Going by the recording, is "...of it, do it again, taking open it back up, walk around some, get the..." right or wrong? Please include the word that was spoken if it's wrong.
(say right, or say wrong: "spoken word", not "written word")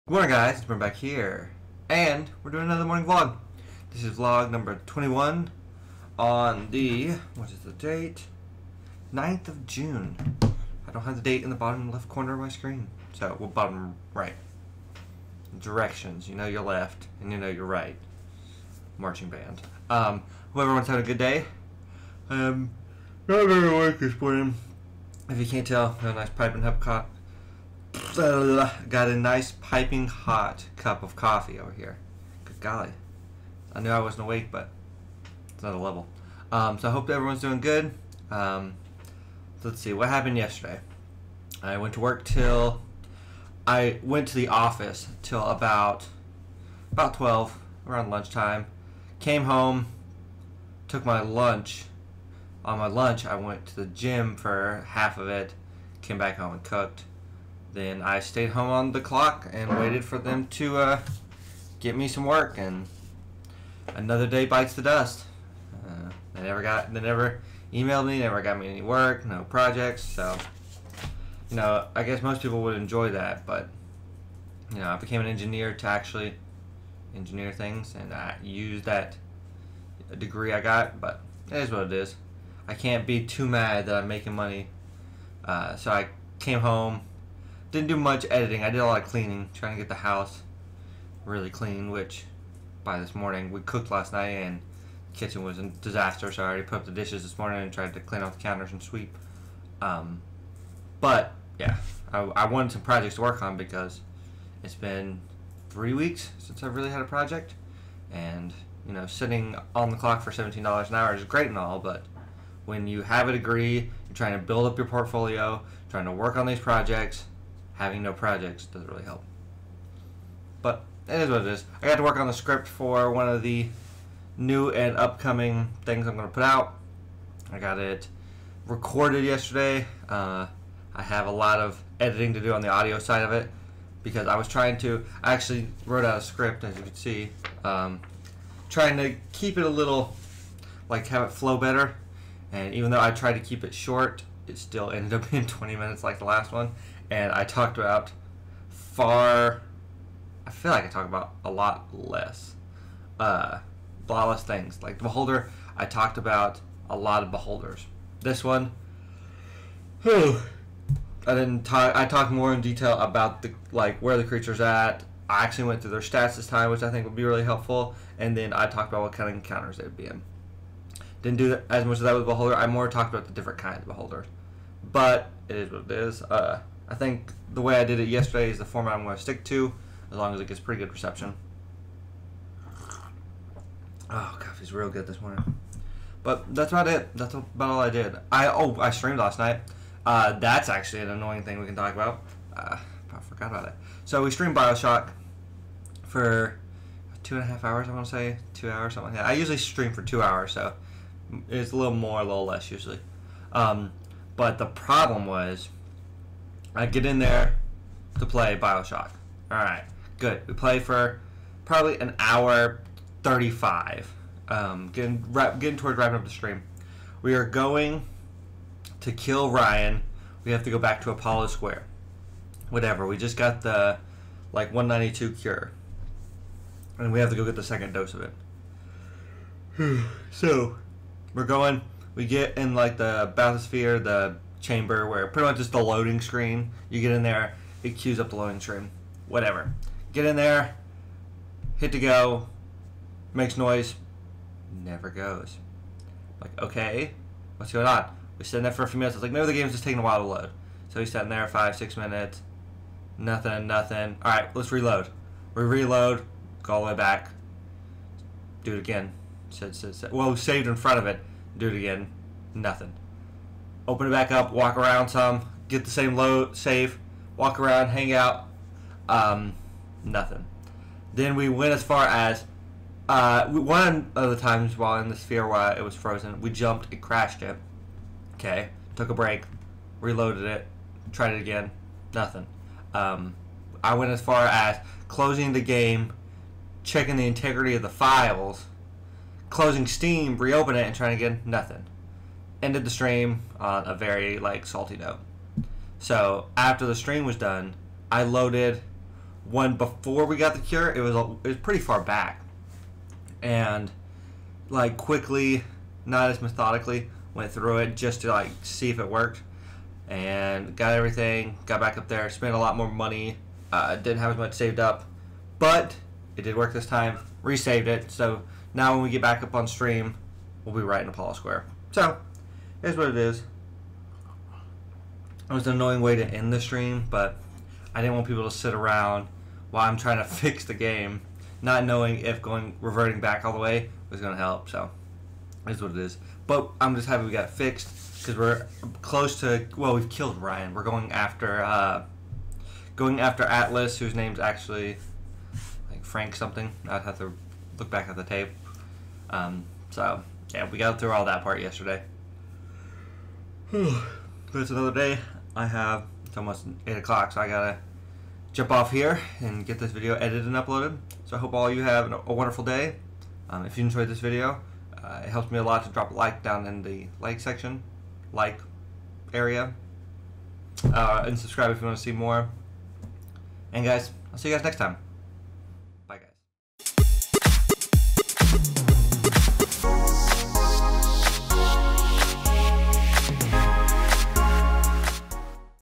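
wrong: "nothing", not "taking".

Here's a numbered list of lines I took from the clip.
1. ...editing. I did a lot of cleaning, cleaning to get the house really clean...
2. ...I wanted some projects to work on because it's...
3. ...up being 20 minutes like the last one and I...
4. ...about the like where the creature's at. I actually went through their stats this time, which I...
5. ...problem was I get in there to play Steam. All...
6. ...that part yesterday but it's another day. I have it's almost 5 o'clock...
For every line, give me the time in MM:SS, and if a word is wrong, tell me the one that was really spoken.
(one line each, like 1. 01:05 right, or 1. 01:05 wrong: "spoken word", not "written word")
1. 01:28 wrong: "trying", not "cleaning"
2. 01:42 right
3. 02:25 right
4. 02:42 right
5. 03:24 wrong: "Bioshock", not "Steam"
6. 05:51 wrong: "8", not "5".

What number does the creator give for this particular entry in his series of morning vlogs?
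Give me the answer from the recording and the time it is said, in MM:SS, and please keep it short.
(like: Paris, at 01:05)
21, at 00:04.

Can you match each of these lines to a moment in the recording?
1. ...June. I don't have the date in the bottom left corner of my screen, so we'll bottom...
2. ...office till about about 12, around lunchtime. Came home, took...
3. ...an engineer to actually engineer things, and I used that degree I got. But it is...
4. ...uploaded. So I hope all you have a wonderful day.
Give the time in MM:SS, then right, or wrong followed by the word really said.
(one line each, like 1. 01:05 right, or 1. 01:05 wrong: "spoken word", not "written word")
1. 00:09 right
2. 00:44 right
3. 01:15 right
4. 06:00 right.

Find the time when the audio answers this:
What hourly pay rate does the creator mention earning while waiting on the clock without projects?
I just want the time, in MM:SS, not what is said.
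01:50.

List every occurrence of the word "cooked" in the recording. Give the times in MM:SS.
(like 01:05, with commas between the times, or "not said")
00:56, 01:33.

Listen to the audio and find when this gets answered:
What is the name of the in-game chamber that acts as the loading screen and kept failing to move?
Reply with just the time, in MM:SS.
03:53.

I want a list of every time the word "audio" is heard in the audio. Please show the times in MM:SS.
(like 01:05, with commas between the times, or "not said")
02:12.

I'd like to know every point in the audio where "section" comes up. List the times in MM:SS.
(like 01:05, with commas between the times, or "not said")
06:07.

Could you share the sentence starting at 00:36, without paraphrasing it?
Um, so I hope everyone's doing good.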